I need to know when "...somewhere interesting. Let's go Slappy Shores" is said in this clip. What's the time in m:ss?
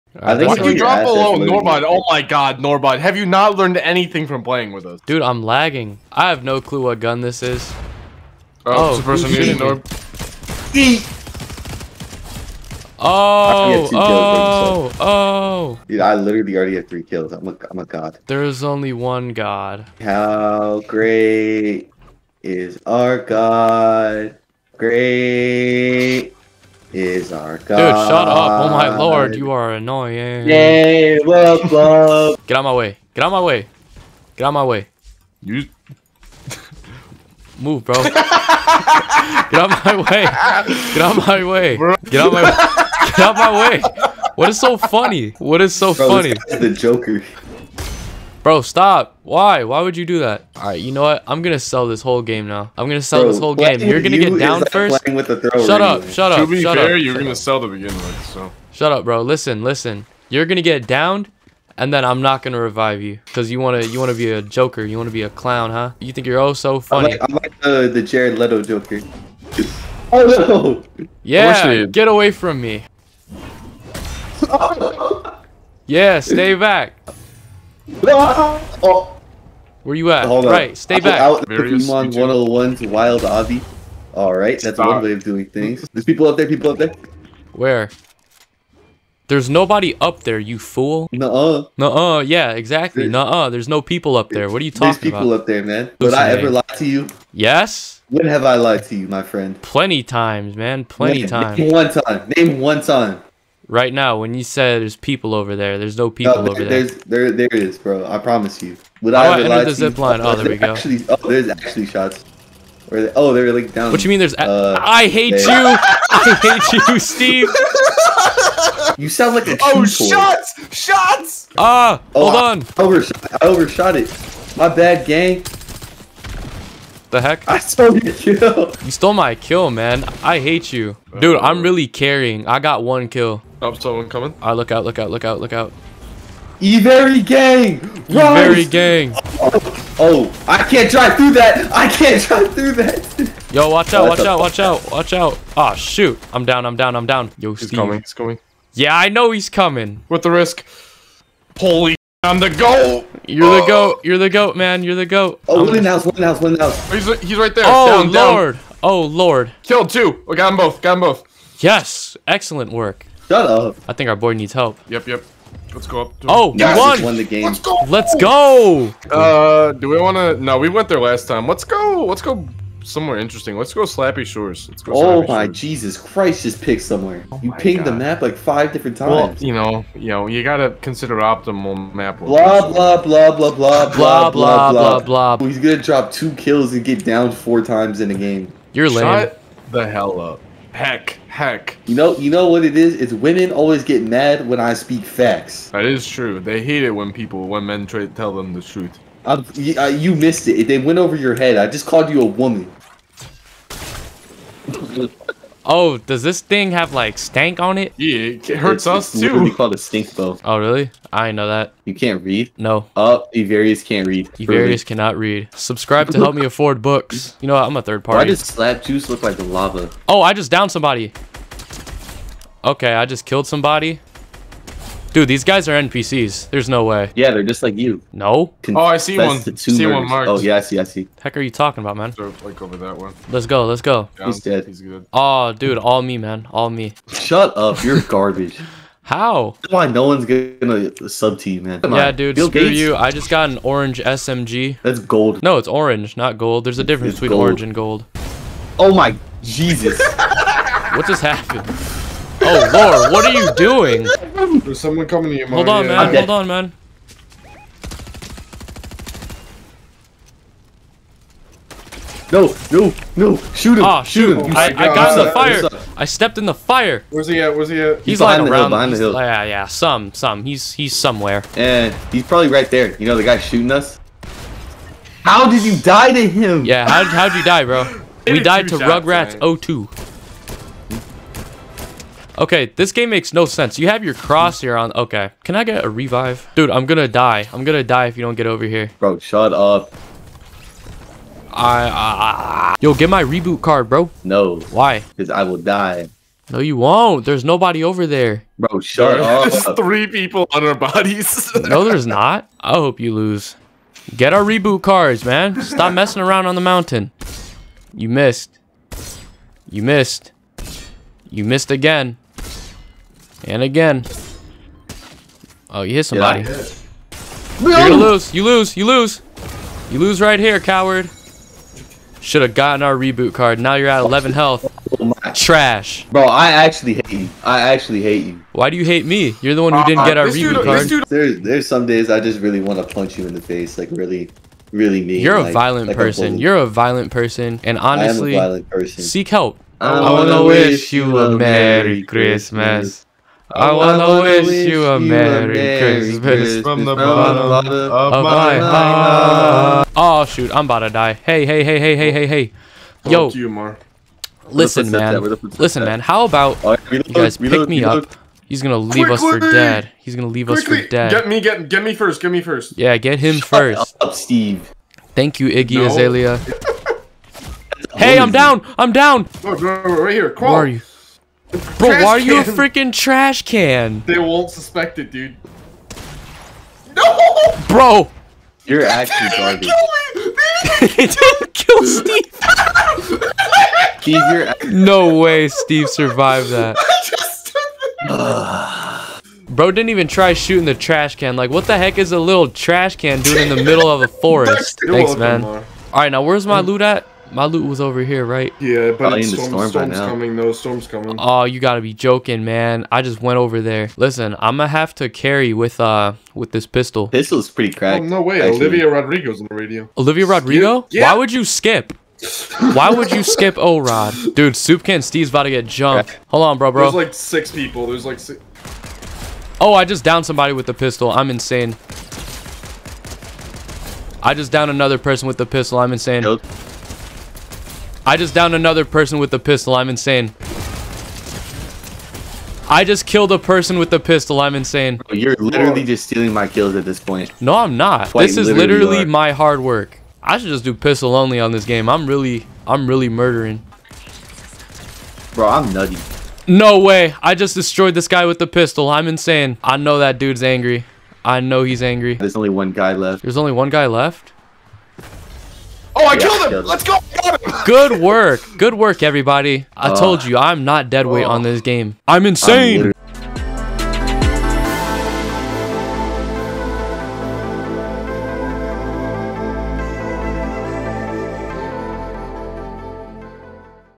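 2:52.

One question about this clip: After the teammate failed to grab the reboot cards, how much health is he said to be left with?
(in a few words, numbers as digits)
11.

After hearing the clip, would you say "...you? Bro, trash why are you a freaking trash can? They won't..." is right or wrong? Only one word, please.
right.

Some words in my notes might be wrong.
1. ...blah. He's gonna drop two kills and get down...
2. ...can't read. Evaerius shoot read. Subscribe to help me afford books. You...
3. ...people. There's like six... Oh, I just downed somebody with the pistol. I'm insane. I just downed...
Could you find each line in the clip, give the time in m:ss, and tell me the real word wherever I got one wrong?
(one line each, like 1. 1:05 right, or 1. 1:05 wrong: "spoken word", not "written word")
1. 3:04 right
2. 3:33 wrong: "cannot", not "shoot"
3. 6:57 right.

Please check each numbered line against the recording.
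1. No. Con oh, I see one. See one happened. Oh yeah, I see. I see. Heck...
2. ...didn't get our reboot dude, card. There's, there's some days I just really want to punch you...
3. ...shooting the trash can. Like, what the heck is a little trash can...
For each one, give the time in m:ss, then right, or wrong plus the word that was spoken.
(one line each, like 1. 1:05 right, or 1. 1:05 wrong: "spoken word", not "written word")
1. 3:48 wrong: "marked", not "happened"
2. 5:29 right
3. 6:30 right.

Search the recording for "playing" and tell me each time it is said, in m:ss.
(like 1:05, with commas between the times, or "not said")
0:04.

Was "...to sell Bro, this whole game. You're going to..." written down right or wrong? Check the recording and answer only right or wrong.
right.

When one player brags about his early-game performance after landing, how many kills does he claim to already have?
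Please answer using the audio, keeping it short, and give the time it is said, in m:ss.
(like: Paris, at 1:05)
3, at 0:16.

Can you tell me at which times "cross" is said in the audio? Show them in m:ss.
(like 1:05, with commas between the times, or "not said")
4:44.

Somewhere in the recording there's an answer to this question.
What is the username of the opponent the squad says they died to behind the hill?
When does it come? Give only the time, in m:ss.
4:38.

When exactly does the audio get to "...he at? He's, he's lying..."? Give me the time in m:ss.
4:27.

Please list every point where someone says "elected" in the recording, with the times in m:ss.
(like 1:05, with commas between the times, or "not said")
not said.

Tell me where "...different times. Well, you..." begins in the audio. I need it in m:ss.
2:58.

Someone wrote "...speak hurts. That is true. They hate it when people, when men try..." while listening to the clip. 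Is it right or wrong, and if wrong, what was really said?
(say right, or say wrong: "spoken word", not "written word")
wrong: "facts", not "hurts".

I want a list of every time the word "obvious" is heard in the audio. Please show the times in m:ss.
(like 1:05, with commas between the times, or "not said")
not said.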